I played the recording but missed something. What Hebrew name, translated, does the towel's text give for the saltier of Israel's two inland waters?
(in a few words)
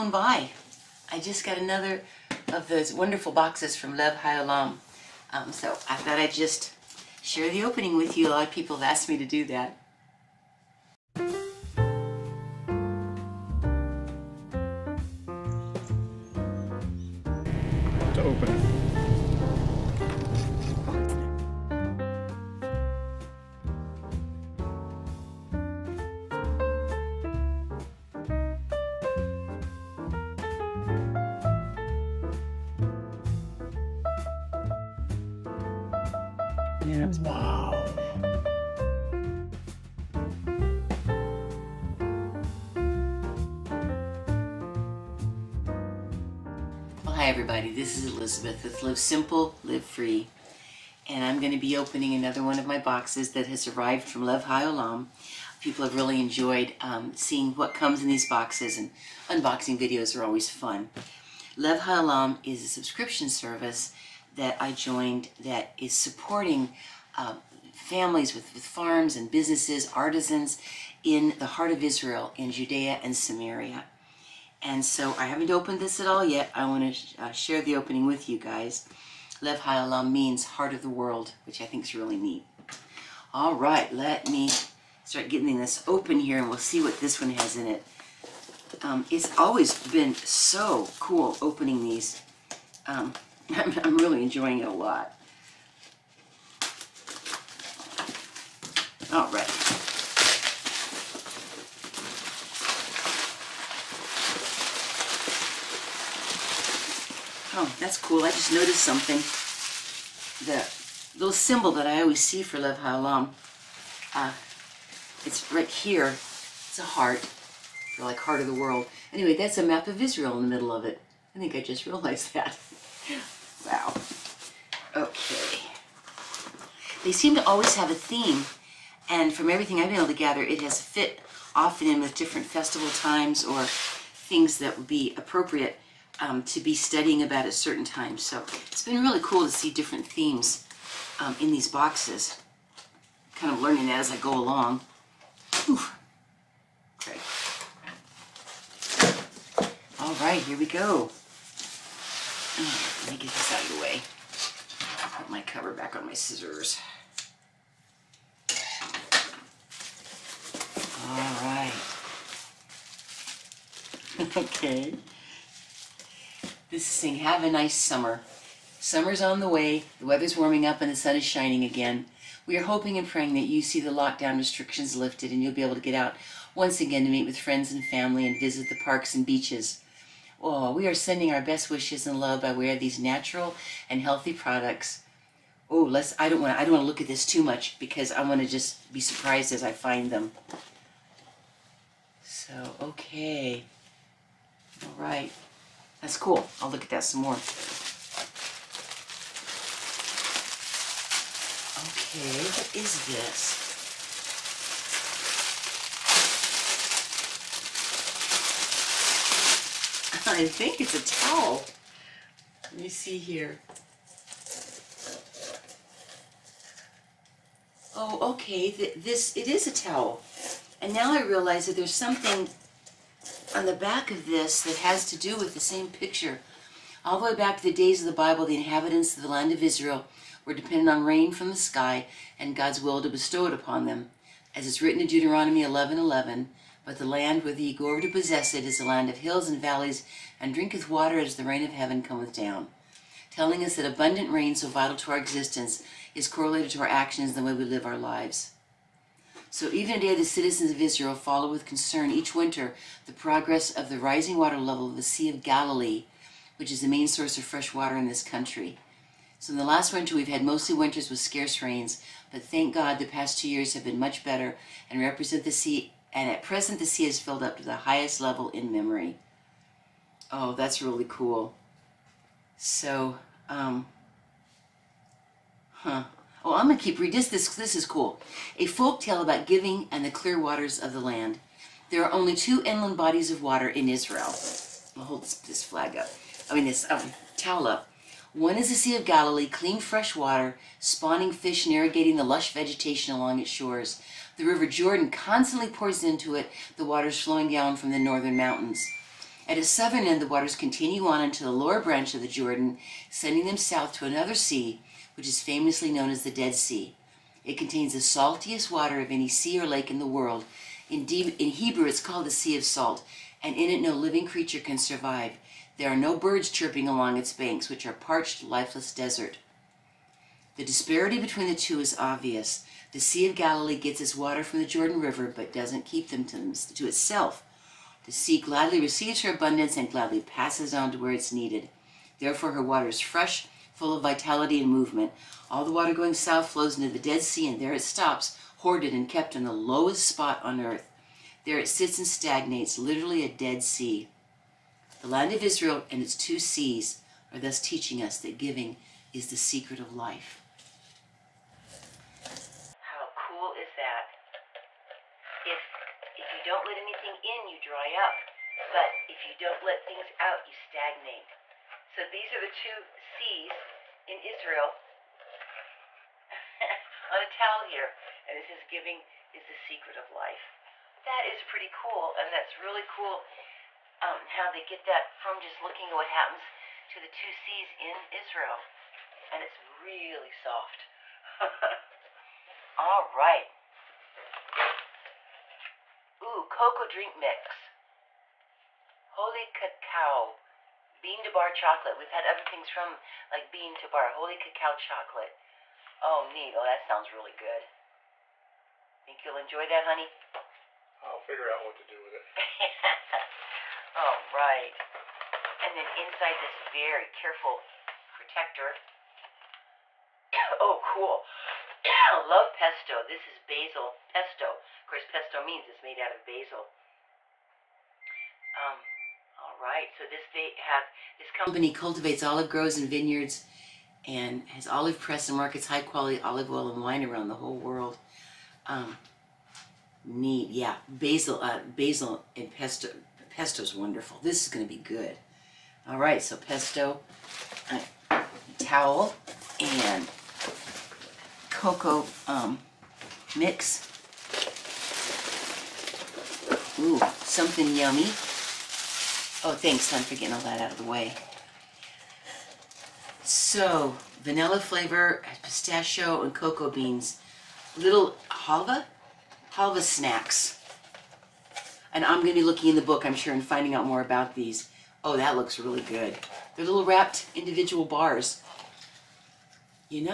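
Sea of Salt.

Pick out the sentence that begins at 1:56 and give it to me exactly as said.
It's a heart, for like heart of the world.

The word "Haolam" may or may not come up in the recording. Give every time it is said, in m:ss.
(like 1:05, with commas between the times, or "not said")
0:04, 1:19, 1:52.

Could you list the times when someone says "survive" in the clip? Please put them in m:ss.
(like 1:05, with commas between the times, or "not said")
5:14.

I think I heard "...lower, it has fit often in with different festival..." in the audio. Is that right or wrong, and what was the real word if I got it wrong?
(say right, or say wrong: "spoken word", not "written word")
wrong: "gather", not "lower".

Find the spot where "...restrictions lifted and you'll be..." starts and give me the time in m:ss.
2:54.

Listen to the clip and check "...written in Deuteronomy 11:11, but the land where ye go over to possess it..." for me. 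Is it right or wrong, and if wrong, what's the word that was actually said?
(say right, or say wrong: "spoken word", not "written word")
right.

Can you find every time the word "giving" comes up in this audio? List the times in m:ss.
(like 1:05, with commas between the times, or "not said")
4:39, 5:48, 6:08.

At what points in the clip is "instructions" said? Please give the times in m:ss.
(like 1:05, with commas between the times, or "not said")
not said.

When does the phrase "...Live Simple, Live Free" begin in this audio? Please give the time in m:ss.
0:48.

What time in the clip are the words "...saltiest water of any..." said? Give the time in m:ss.
5:08.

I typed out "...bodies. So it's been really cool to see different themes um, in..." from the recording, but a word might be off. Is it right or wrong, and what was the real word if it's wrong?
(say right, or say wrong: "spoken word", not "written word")
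wrong: "times", not "bodies".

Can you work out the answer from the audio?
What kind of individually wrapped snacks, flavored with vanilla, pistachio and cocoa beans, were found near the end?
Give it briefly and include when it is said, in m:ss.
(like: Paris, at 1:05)
Halva snacks, at 7:39.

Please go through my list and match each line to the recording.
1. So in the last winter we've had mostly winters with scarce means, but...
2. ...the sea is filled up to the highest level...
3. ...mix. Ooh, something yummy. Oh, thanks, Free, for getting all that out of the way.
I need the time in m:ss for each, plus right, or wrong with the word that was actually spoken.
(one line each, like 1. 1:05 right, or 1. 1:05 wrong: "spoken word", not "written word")
1. 4:19 wrong: "rains", not "means"
2. 4:26 right
3. 7:23 wrong: "Son", not "Free".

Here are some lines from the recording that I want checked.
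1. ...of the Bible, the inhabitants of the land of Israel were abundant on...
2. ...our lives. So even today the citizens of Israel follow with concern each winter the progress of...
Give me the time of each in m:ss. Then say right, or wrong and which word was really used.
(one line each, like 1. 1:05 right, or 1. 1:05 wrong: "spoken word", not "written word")
1. 3:48 wrong: "dependent", not "abundant"
2. 4:07 right.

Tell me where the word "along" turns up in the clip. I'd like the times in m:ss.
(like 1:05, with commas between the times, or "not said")
2:24, 4:53, 5:16.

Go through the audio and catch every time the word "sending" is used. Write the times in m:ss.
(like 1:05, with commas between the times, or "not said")
3:00, 5:03.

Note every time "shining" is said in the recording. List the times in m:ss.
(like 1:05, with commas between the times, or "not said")
2:51.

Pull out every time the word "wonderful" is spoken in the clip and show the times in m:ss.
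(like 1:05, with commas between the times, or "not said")
0:02, 7:13.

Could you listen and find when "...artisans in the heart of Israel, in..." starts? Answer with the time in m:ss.
1:09.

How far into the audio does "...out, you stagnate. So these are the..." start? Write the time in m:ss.
6:00.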